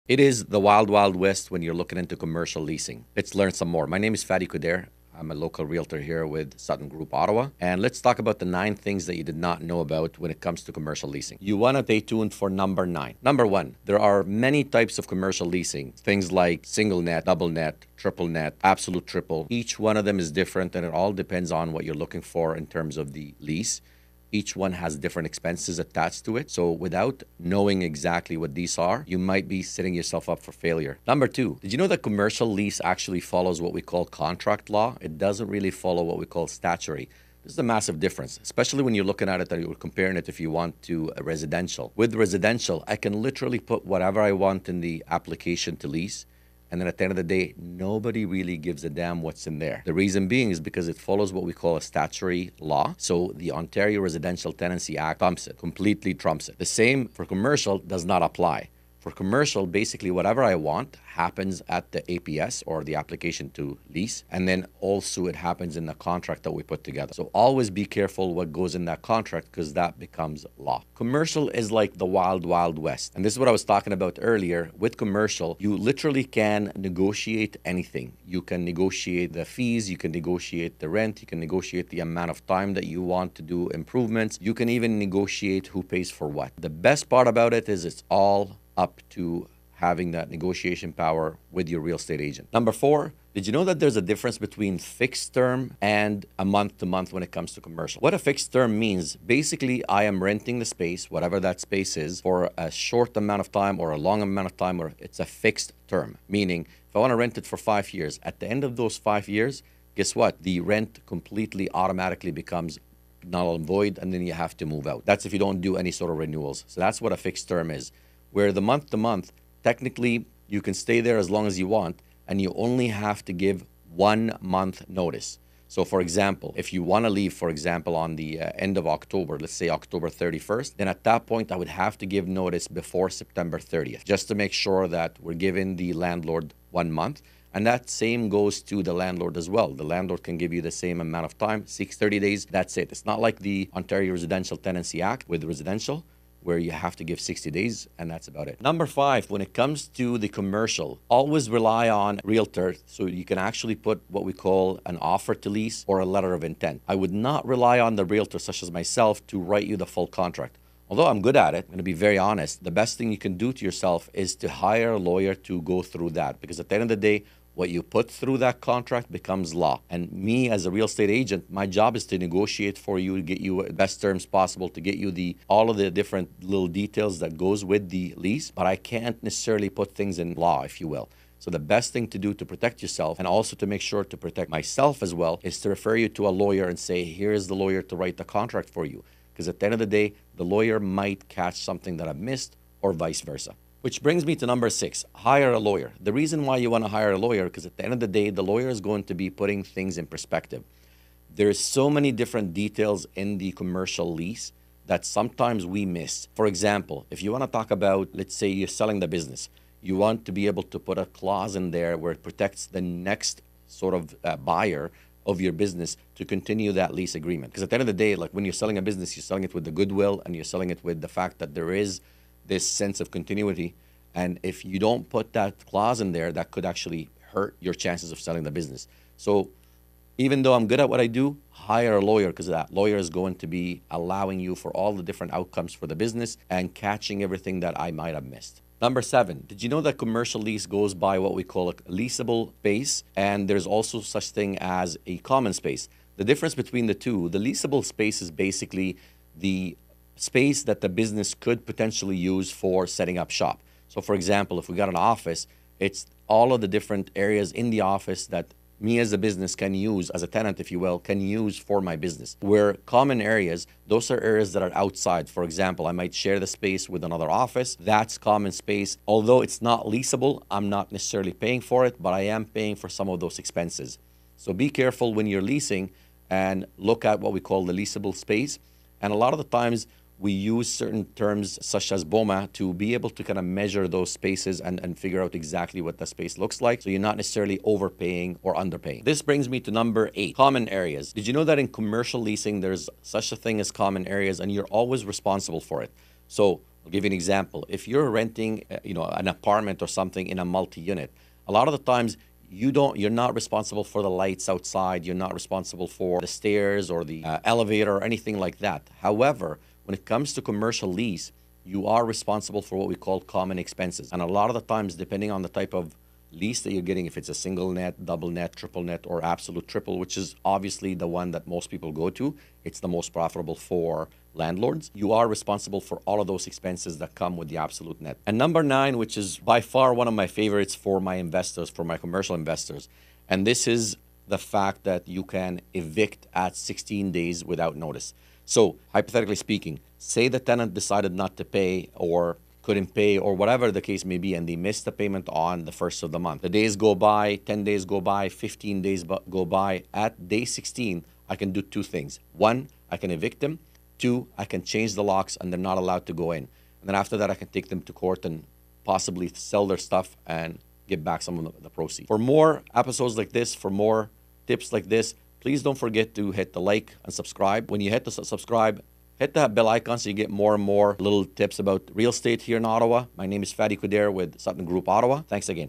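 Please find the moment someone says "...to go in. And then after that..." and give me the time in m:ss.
5:56.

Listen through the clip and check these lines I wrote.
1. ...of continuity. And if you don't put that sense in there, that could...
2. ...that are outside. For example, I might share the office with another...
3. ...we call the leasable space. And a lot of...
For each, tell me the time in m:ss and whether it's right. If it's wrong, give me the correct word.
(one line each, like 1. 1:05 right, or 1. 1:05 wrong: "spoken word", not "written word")
1. 3:42 wrong: "clause", not "sense"
2. 4:24 wrong: "space", not "office"
3. 4:37 right.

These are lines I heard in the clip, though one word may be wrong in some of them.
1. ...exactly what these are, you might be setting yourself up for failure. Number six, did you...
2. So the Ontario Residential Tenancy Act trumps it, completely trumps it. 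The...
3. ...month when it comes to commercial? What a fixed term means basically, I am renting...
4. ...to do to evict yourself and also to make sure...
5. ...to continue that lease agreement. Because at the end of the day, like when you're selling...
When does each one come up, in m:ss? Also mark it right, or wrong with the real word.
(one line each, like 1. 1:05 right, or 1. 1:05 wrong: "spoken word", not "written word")
1. 0:27 wrong: "two", not "six"
2. 0:52 right
3. 1:36 right
4. 3:02 wrong: "protect", not "evict"
5. 3:36 right.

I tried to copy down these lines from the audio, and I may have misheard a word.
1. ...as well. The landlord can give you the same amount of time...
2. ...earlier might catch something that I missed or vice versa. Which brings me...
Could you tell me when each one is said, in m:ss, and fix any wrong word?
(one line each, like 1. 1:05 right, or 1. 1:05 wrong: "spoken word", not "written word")
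1. 2:19 right
2. 3:10 wrong: "lawyer", not "earlier".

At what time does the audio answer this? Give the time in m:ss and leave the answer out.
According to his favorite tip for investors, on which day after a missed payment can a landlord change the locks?
5:50.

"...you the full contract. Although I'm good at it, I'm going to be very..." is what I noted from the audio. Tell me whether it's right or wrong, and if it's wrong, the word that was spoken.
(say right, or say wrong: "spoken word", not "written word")
right.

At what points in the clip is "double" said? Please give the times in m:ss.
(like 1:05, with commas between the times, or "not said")
0:17, 5:18.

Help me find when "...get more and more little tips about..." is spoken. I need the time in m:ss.
6:10.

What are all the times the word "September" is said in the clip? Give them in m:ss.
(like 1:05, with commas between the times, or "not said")
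2:13.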